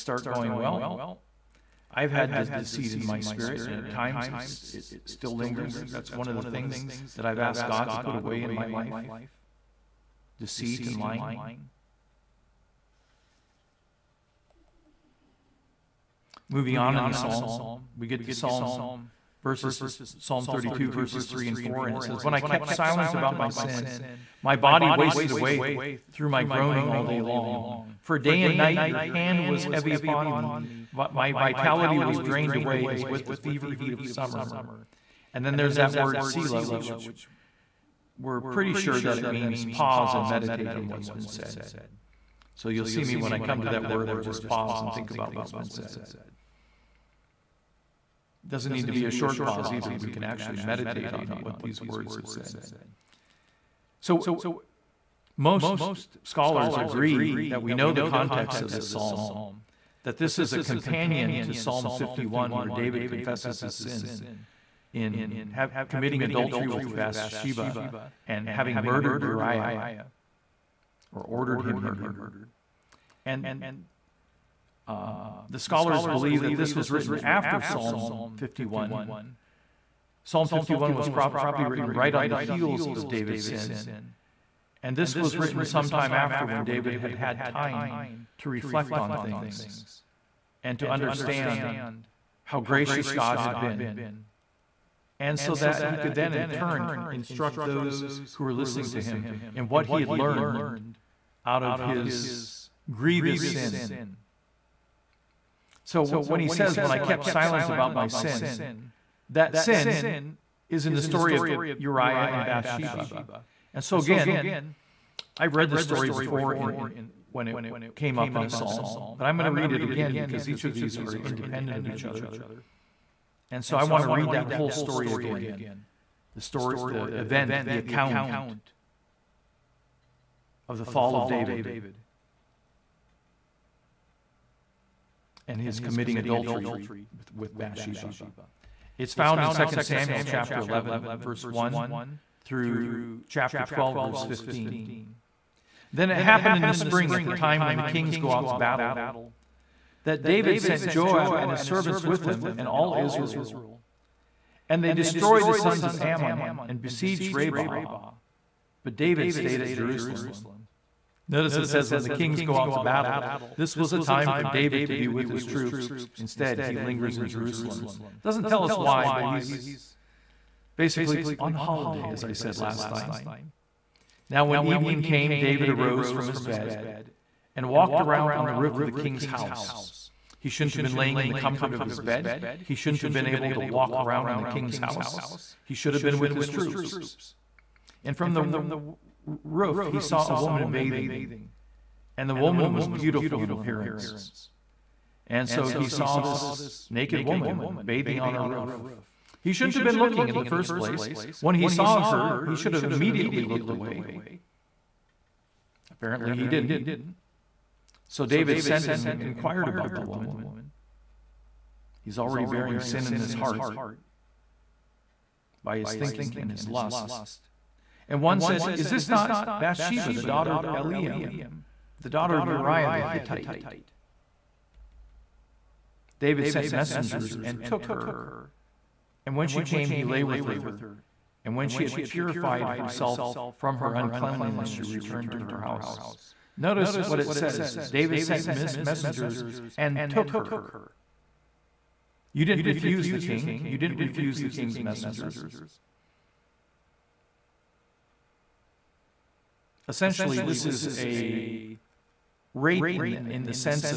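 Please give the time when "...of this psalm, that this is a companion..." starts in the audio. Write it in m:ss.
0:58.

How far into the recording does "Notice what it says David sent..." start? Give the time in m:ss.
3:56.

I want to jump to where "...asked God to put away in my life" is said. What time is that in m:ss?
0:07.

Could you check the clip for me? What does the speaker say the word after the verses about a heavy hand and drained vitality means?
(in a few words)
Pause and meditate.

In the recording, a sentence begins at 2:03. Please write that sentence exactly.
And so I want to read that whole story again.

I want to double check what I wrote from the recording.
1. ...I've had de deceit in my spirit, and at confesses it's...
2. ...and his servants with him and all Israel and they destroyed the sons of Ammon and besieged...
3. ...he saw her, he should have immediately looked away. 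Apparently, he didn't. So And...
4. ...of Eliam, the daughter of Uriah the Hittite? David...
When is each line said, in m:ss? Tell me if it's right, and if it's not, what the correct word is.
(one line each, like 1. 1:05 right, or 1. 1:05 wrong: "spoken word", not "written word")
1. 0:01 wrong: "times", not "confesses"
2. 2:31 right
3. 3:21 wrong: "David", not "And"
4. 3:40 right.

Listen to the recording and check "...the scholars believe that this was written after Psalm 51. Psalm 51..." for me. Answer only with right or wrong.
right.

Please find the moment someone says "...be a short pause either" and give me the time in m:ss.
0:48.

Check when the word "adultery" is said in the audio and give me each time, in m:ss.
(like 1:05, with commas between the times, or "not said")
1:06, 2:16.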